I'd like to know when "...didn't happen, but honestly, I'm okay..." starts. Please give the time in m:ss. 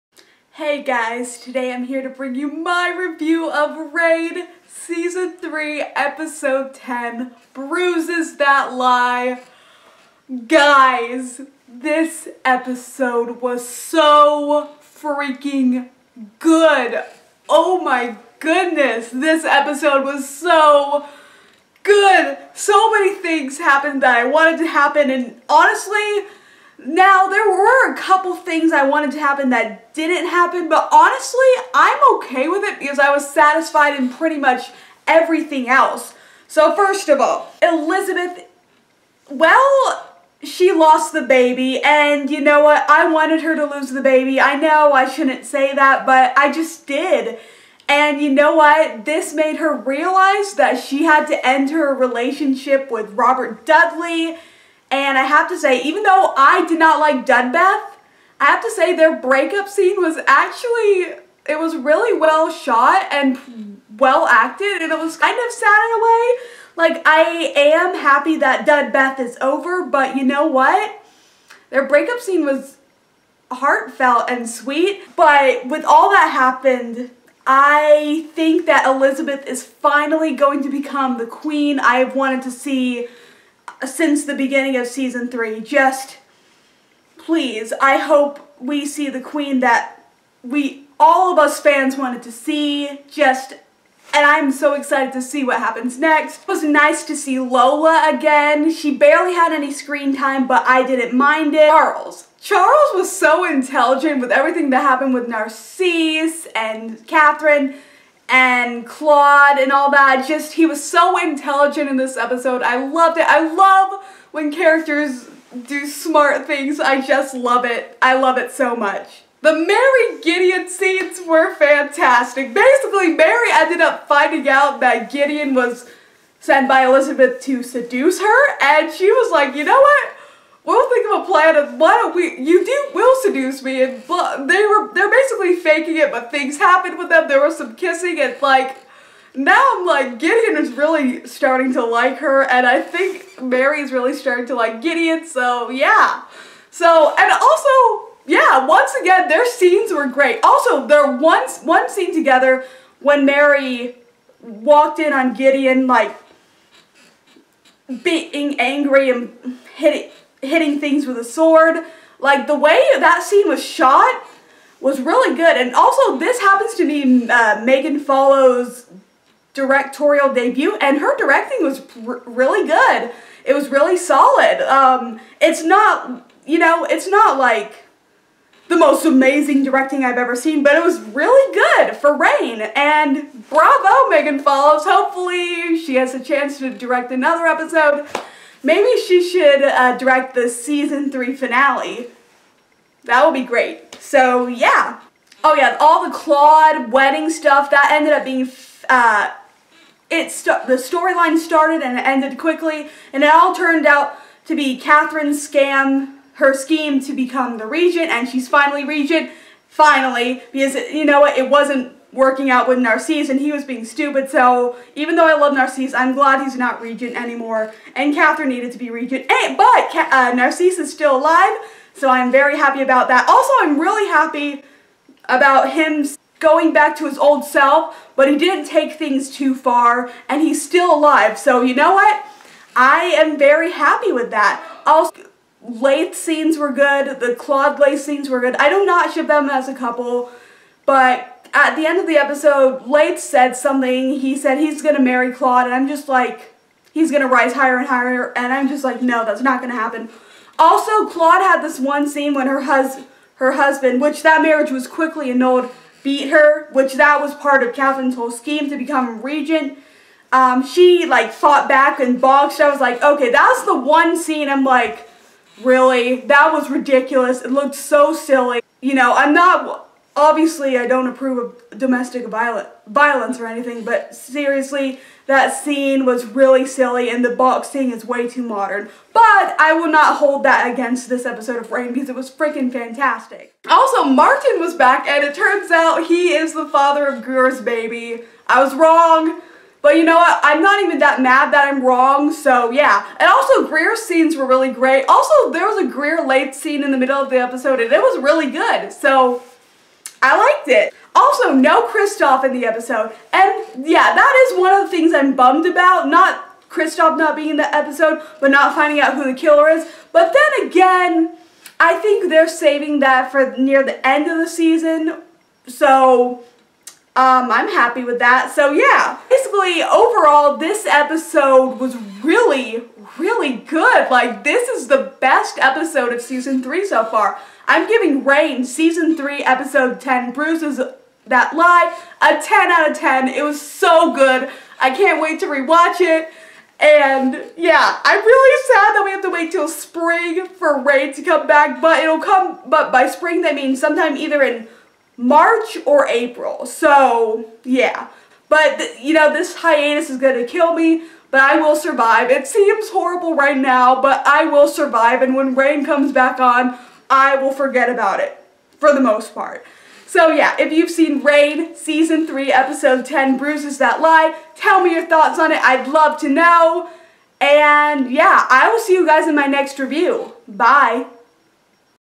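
0:29.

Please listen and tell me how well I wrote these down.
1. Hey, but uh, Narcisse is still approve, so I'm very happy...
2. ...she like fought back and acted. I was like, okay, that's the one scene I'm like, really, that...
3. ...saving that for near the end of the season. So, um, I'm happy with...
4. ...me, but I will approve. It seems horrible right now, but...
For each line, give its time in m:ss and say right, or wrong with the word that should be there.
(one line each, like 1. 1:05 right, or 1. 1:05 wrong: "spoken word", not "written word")
1. 3:39 wrong: "alive", not "approve"
2. 4:20 wrong: "boxed", not "acted"
3. 5:12 right
4. 5:50 wrong: "survive", not "approve".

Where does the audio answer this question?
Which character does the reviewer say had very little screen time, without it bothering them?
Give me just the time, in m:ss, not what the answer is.
1:37.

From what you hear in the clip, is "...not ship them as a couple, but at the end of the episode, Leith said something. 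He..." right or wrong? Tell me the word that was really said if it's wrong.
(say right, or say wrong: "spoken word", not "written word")
right.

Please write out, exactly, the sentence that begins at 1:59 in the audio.
The Mary Gideon scenes were fantastic.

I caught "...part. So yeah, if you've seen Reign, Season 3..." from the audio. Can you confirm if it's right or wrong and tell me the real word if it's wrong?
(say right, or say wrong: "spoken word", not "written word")
right.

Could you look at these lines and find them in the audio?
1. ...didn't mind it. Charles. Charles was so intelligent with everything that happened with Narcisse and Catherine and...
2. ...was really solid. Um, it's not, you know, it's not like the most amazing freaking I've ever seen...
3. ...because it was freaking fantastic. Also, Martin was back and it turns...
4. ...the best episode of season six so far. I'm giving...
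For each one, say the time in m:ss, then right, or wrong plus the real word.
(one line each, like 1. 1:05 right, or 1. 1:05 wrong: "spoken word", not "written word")
1. 1:40 right
2. 2:53 wrong: "directing", not "freaking"
3. 4:41 right
4. 5:24 wrong: "three", not "six".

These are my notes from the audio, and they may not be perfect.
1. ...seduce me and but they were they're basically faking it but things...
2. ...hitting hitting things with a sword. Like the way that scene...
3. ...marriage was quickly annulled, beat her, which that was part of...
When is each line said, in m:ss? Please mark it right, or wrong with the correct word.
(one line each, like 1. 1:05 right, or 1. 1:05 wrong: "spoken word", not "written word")
1. 2:13 right
2. 2:39 right
3. 4:14 right.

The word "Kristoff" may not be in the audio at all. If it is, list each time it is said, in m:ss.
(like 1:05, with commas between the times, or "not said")
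5:01, 5:06.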